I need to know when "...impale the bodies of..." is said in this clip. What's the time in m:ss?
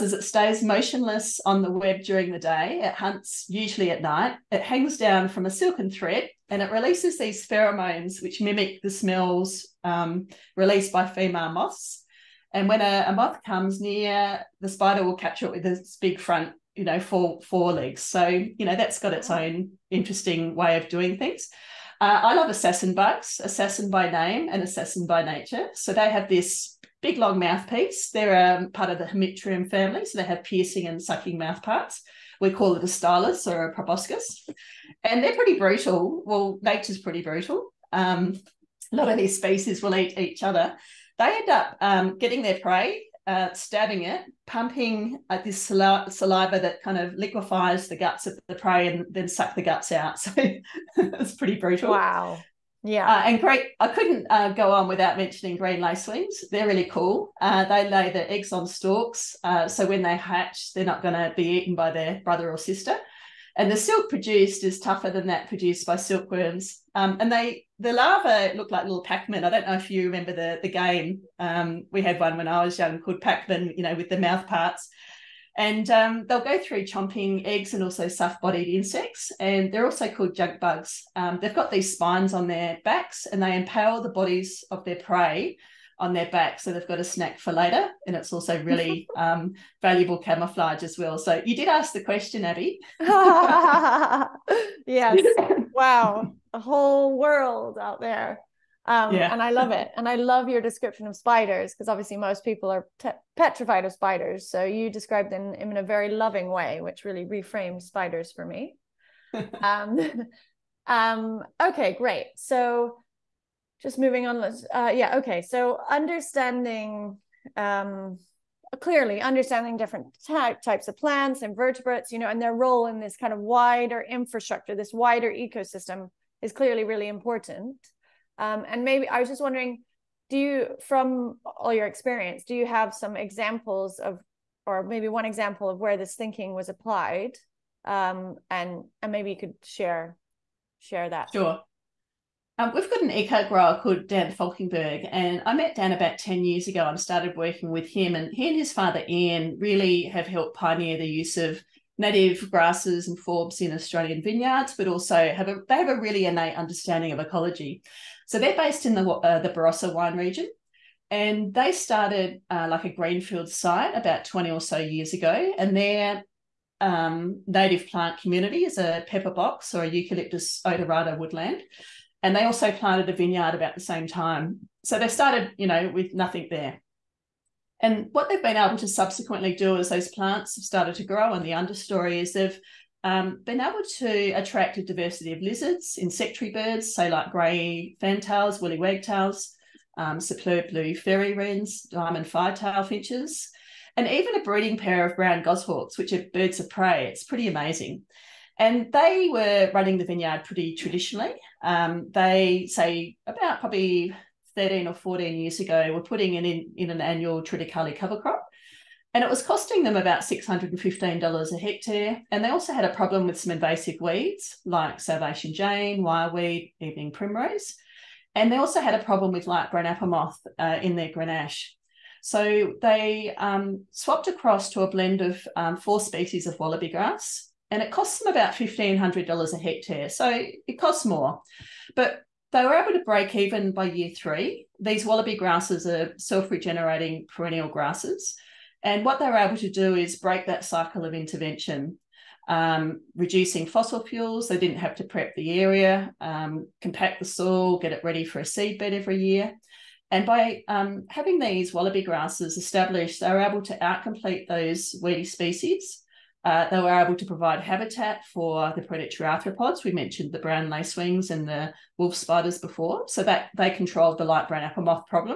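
1:23.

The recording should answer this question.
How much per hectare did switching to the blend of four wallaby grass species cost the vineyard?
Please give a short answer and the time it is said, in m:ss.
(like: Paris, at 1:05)
$1,500, at 3:48.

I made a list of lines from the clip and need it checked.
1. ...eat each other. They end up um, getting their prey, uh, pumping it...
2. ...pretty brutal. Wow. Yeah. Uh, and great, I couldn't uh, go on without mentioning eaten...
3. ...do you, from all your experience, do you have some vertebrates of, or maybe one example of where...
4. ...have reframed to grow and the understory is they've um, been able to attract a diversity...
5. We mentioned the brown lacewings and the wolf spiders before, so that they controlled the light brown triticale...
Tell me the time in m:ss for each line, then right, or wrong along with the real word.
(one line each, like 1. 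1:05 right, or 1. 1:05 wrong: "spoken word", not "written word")
1. 0:39 wrong: "stabbing", not "pumping"
2. 0:51 wrong: "green", not "eaten"
3. 2:10 wrong: "examples", not "vertebrates"
4. 3:00 wrong: "started", not "reframed"
5. 4:19 wrong: "apple", not "triticale".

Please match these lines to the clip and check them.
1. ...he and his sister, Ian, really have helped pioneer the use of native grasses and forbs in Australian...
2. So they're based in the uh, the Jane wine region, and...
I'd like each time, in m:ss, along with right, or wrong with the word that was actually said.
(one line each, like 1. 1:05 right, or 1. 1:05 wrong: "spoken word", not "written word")
1. 2:28 wrong: "father", not "sister"
2. 2:38 wrong: "Barossa", not "Jane".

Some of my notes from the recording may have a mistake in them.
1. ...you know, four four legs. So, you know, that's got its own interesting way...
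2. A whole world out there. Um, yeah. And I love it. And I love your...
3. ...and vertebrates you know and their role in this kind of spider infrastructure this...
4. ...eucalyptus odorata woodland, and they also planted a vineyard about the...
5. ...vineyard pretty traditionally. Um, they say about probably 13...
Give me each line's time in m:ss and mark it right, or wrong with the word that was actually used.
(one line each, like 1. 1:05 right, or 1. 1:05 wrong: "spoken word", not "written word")
1. 0:16 right
2. 1:36 right
3. 2:01 wrong: "wider", not "spider"
4. 2:49 right
5. 3:20 right.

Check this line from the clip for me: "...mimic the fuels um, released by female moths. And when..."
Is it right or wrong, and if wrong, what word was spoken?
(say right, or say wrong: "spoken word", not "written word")
wrong: "smells", not "fuels".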